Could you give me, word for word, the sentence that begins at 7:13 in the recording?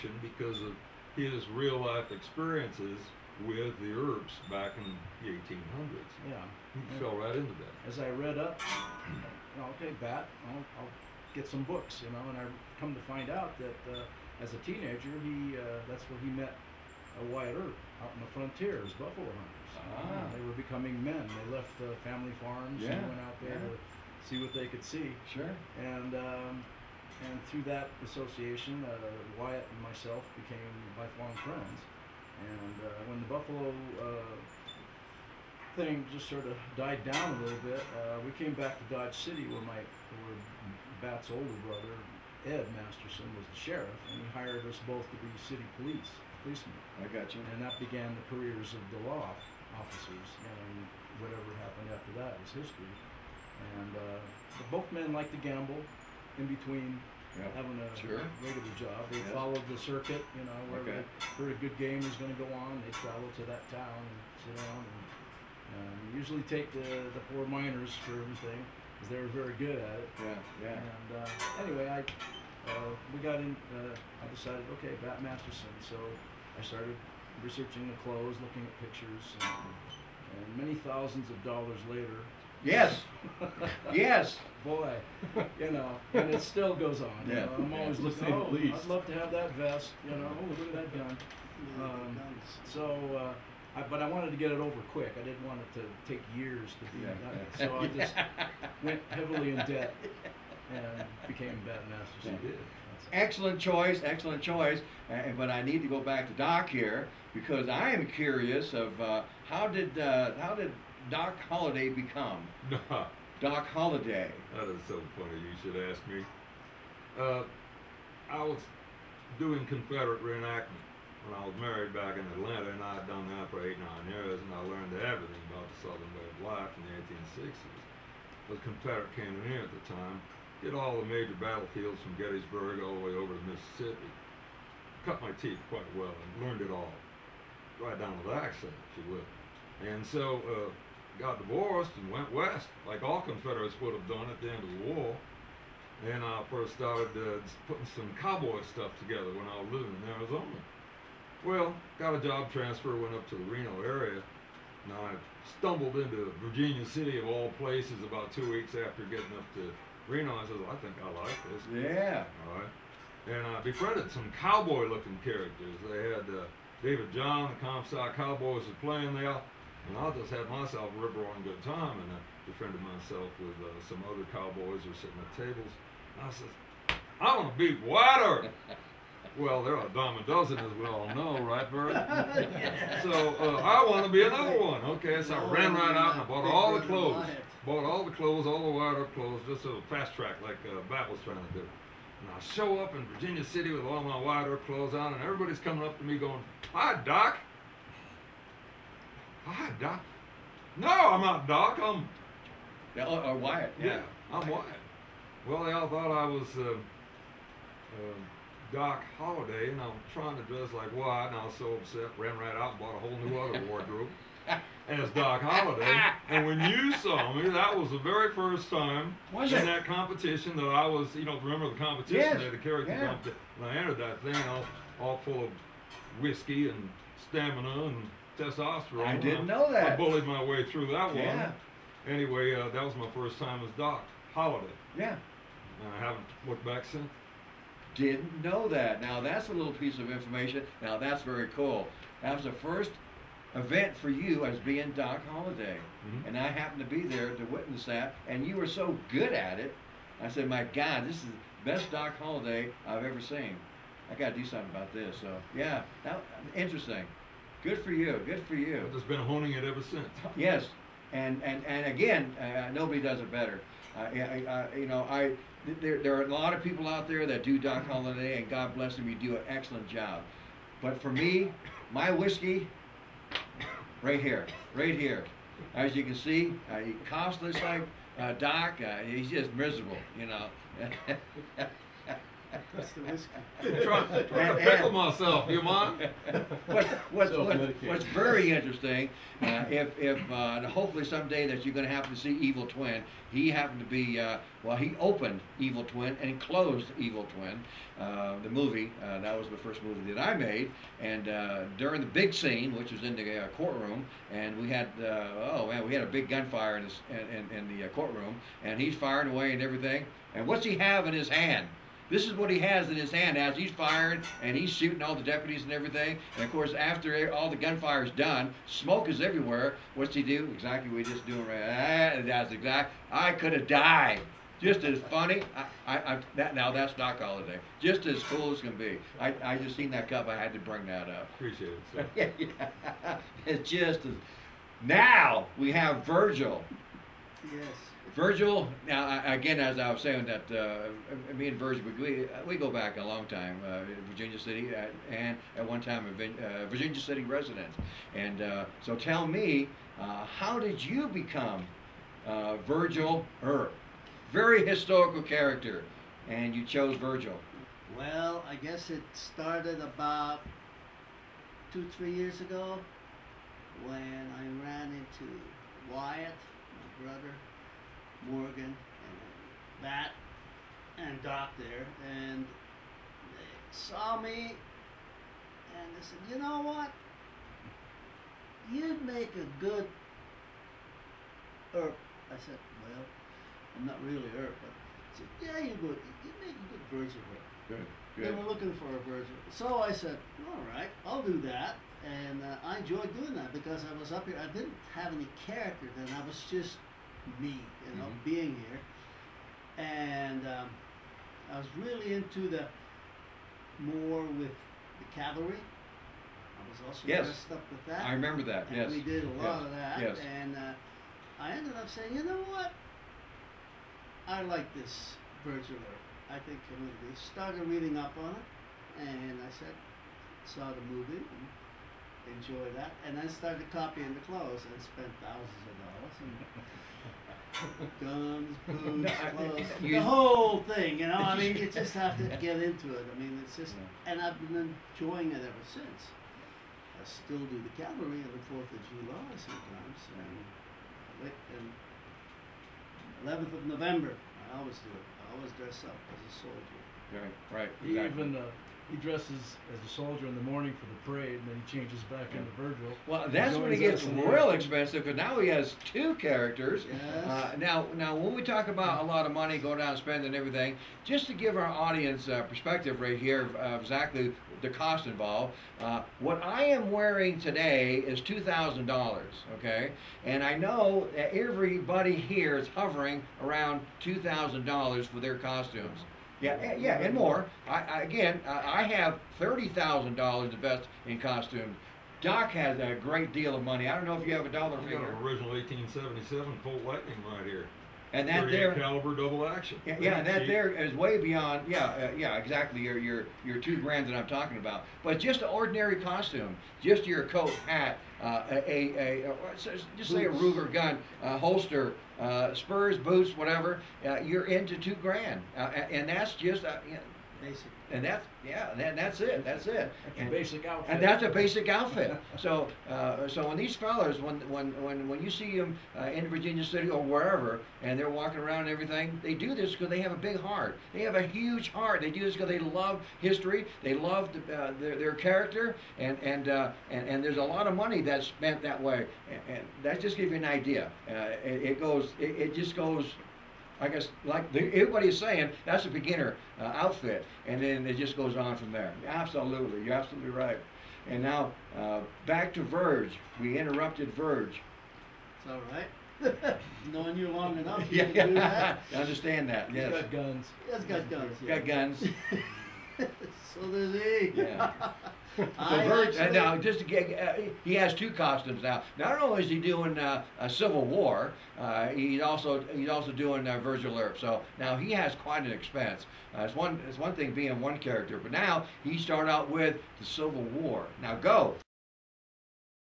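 I mean, it's just, and I've been enjoying it ever since.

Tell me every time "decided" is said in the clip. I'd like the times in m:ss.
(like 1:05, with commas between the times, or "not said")
1:14.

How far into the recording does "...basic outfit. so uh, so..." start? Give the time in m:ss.
8:31.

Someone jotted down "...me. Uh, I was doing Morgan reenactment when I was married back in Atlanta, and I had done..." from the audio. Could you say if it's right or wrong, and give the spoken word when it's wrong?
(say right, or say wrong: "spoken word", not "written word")
wrong: "Confederate", not "Morgan".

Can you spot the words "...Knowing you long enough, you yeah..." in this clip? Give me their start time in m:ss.
9:06.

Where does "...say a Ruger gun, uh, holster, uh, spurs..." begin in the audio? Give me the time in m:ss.
8:20.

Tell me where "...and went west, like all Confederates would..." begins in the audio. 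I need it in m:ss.
2:22.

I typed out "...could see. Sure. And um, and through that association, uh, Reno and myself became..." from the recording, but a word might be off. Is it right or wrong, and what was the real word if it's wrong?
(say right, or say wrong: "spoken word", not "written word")
wrong: "Wyatt", not "Reno".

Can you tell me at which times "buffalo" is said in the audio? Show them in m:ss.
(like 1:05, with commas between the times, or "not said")
0:18, 0:33.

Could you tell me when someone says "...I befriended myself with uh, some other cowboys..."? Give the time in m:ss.
2:52.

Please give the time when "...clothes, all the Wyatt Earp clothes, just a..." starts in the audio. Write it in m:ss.
3:08.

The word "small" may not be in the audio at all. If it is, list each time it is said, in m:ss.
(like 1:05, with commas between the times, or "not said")
not said.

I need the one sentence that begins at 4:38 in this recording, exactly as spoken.
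Uh, he's just miserable, you know.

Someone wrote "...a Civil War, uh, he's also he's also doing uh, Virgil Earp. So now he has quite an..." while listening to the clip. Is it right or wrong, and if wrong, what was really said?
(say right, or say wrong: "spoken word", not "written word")
right.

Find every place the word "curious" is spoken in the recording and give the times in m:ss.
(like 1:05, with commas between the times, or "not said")
1:48.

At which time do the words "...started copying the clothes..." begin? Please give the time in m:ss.
7:03.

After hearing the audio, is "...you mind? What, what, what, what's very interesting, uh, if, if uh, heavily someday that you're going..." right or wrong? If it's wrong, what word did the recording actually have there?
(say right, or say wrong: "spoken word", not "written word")
wrong: "hopefully", not "heavily".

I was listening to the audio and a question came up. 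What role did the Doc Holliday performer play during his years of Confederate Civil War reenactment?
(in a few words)
Confederate cannoneer.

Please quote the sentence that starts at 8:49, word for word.
And, and that just gives you an idea.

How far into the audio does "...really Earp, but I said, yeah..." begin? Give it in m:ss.
6:24.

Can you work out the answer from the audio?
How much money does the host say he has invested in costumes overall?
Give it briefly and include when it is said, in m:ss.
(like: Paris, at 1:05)
$30,000, at 7:59.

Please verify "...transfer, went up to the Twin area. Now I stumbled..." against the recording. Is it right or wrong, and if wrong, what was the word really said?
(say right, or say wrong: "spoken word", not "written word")
wrong: "Reno", not "Twin".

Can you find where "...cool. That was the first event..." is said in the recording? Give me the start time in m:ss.
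4:01.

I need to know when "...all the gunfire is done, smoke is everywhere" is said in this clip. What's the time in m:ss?
5:17.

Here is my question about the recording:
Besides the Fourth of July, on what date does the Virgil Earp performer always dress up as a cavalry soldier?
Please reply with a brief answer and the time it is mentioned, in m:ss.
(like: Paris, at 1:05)
11th of November, at 7:23.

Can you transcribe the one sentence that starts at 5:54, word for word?
Very historical character, and you chose Virgil.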